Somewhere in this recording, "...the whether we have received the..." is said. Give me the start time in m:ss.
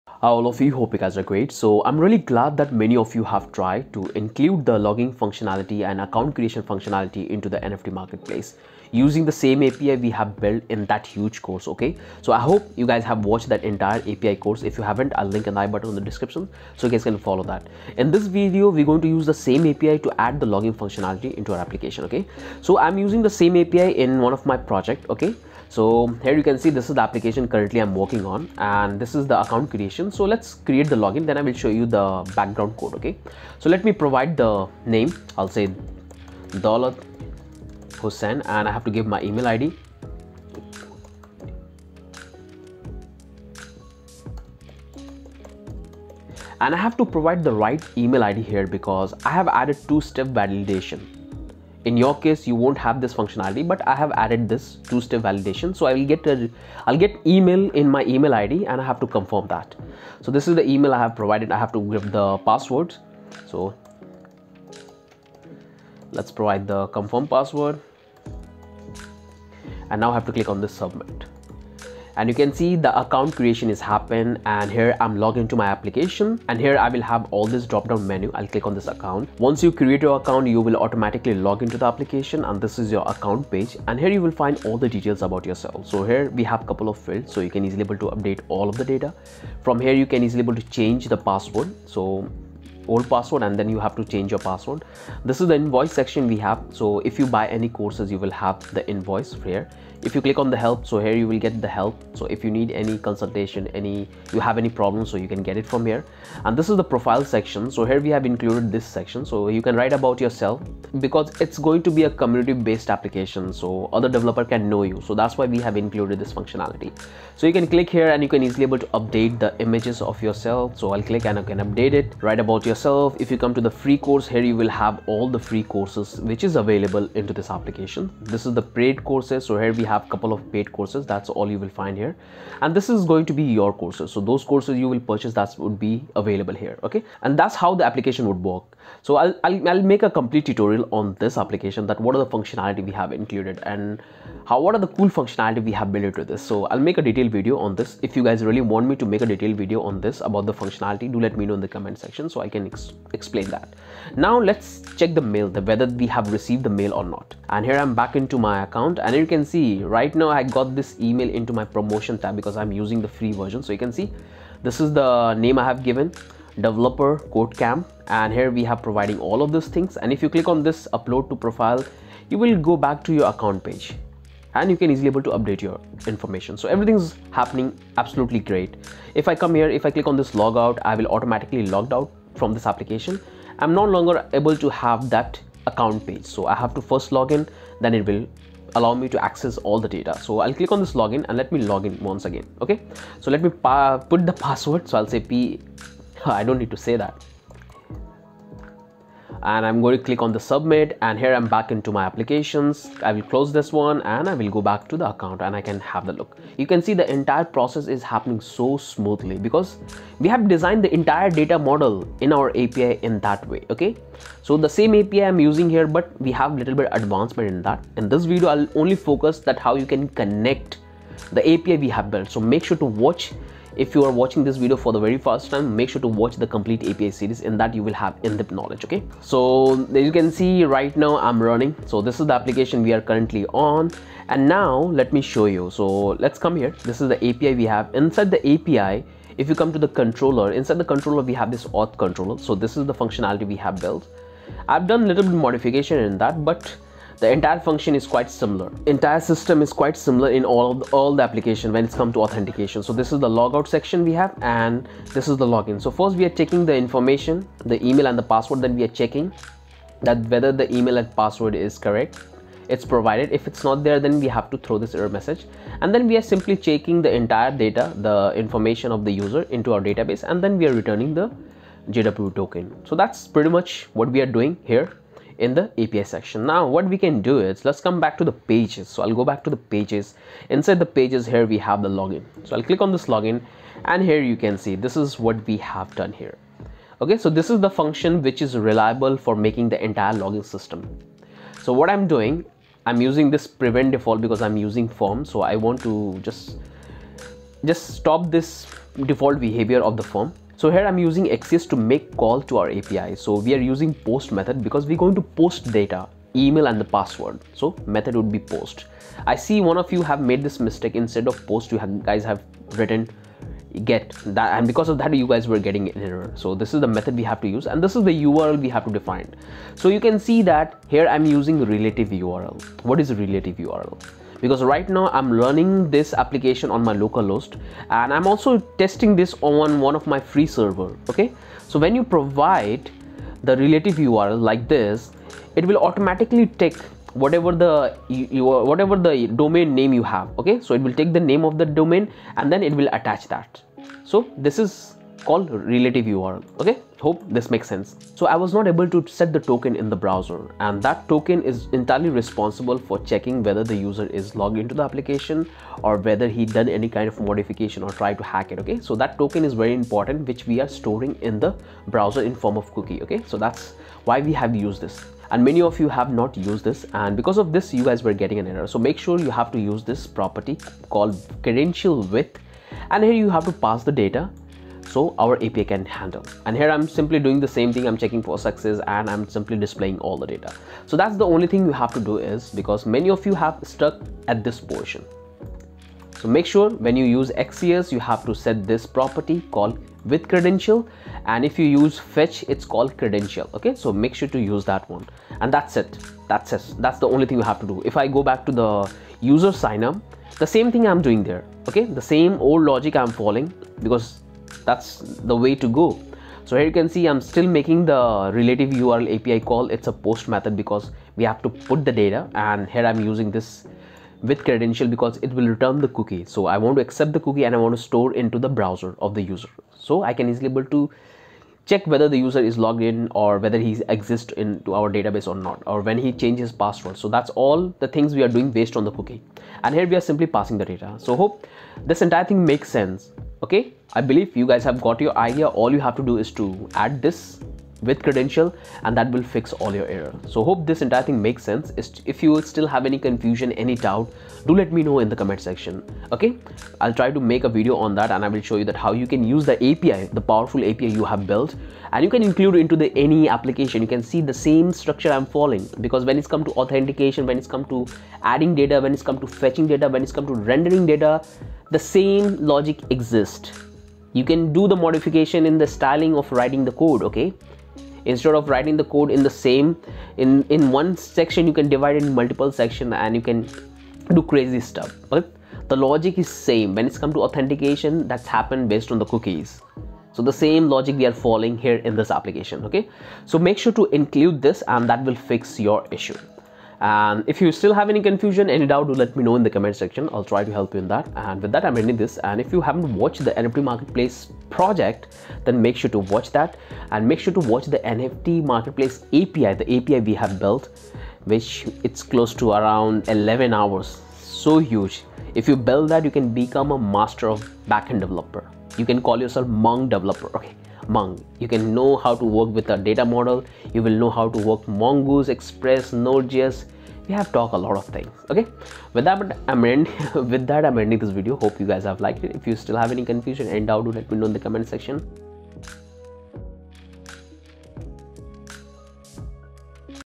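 2:35.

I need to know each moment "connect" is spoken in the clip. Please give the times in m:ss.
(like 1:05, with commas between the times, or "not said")
3:40.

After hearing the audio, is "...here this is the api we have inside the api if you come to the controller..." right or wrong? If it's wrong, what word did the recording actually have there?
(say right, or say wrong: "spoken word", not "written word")
right.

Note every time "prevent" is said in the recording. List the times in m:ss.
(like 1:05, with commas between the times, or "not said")
4:53.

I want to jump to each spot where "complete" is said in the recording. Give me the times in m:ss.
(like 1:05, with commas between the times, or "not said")
2:20, 3:46.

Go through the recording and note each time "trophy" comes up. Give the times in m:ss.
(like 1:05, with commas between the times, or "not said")
not said.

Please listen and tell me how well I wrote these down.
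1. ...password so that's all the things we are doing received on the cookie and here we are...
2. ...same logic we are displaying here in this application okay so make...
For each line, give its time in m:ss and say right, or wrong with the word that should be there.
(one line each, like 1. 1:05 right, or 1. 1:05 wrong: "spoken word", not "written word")
1. 7:06 wrong: "based", not "received"
2. 8:00 wrong: "following", not "displaying".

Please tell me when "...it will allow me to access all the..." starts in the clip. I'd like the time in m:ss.
3:07.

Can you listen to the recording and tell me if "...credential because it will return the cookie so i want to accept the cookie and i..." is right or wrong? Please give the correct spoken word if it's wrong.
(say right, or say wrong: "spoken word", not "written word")
right.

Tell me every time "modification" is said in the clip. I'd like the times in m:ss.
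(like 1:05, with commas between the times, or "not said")
4:05, 5:57, 7:44.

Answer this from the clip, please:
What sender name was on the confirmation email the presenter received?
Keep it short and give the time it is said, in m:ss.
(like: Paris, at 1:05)
developer Code cam, at 2:46.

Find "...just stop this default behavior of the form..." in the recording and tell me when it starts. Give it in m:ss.
4:57.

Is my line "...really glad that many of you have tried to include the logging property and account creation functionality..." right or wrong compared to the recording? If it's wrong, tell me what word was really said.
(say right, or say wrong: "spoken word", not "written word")
wrong: "functionality", not "property".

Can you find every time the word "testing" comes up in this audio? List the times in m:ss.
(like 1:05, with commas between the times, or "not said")
5:28.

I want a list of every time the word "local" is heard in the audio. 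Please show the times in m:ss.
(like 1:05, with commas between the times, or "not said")
5:26.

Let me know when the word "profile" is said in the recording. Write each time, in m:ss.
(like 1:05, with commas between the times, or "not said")
1:46, 2:51.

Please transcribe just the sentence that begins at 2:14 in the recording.
So those courses you will purchase that would be available here.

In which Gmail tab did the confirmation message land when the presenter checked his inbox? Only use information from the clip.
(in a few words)
Promotion tab.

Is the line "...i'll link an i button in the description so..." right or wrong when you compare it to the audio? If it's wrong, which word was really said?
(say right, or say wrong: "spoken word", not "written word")
right.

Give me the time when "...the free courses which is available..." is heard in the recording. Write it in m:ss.
2:05.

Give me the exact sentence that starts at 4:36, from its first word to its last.
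Now what we can do is let's come back to the pages.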